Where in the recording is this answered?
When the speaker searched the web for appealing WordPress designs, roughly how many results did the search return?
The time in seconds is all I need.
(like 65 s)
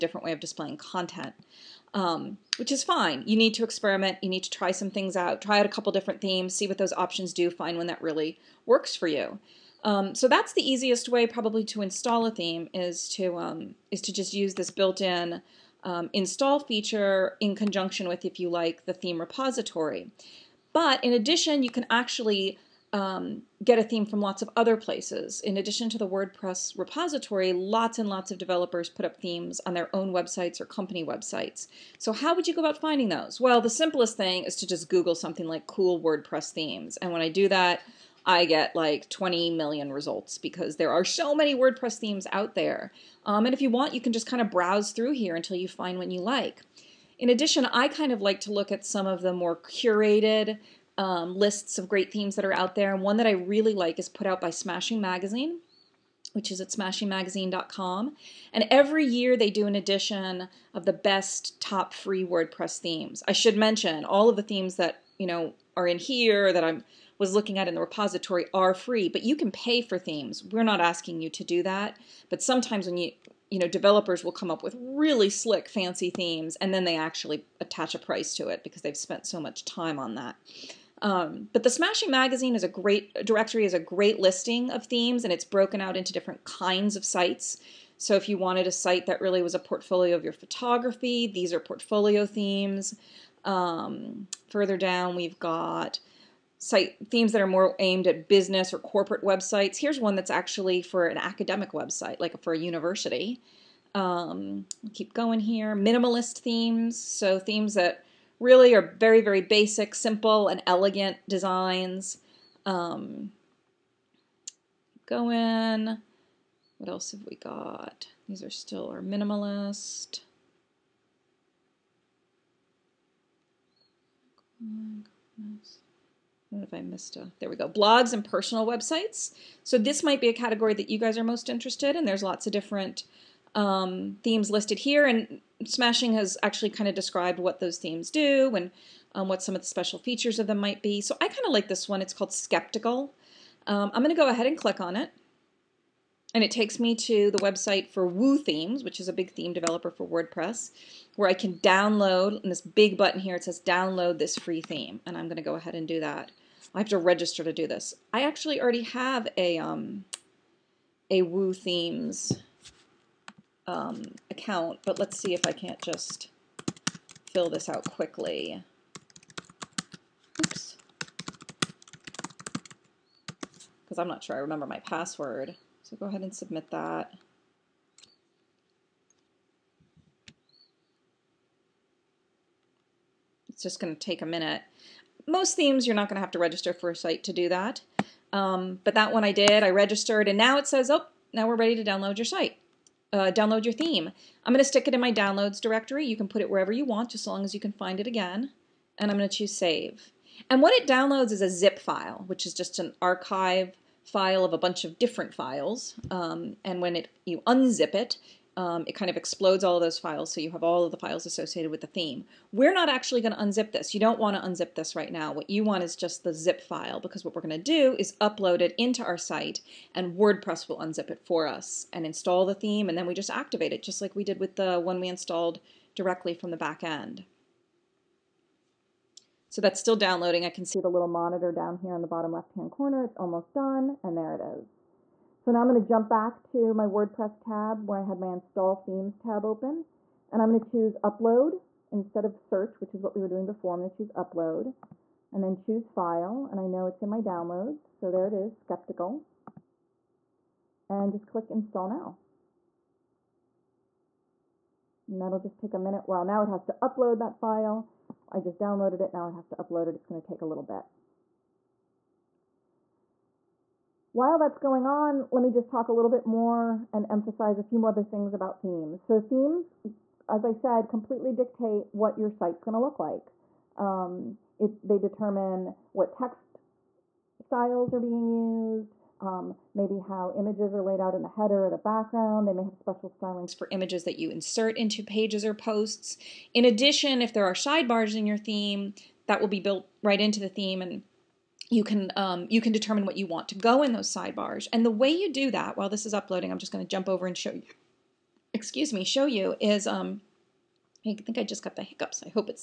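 39 s.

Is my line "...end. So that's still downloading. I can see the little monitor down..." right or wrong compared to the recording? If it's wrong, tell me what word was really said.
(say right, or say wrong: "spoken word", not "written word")
right.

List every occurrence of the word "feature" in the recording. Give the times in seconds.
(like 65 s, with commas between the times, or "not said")
16 s, 139 s.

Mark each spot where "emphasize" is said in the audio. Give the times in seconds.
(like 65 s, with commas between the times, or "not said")
267 s.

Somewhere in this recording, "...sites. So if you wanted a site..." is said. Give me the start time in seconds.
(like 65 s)
87 s.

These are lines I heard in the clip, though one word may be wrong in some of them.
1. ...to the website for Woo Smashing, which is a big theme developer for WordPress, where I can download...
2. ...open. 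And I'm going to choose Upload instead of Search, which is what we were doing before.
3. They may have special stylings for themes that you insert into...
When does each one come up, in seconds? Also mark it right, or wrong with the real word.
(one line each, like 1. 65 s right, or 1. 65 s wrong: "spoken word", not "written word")
1. 146 s wrong: "Themes", not "Smashing"
2. 239 s right
3. 282 s wrong: "images", not "themes".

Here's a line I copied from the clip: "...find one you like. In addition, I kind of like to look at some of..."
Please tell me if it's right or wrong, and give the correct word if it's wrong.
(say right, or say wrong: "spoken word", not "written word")
right.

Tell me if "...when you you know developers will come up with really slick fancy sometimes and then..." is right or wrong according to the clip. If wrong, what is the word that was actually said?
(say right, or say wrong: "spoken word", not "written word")
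wrong: "themes", not "sometimes".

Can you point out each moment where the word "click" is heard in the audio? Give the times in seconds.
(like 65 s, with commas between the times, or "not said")
144 s, 251 s.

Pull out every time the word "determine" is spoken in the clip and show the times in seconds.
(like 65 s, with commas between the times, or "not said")
274 s, 292 s.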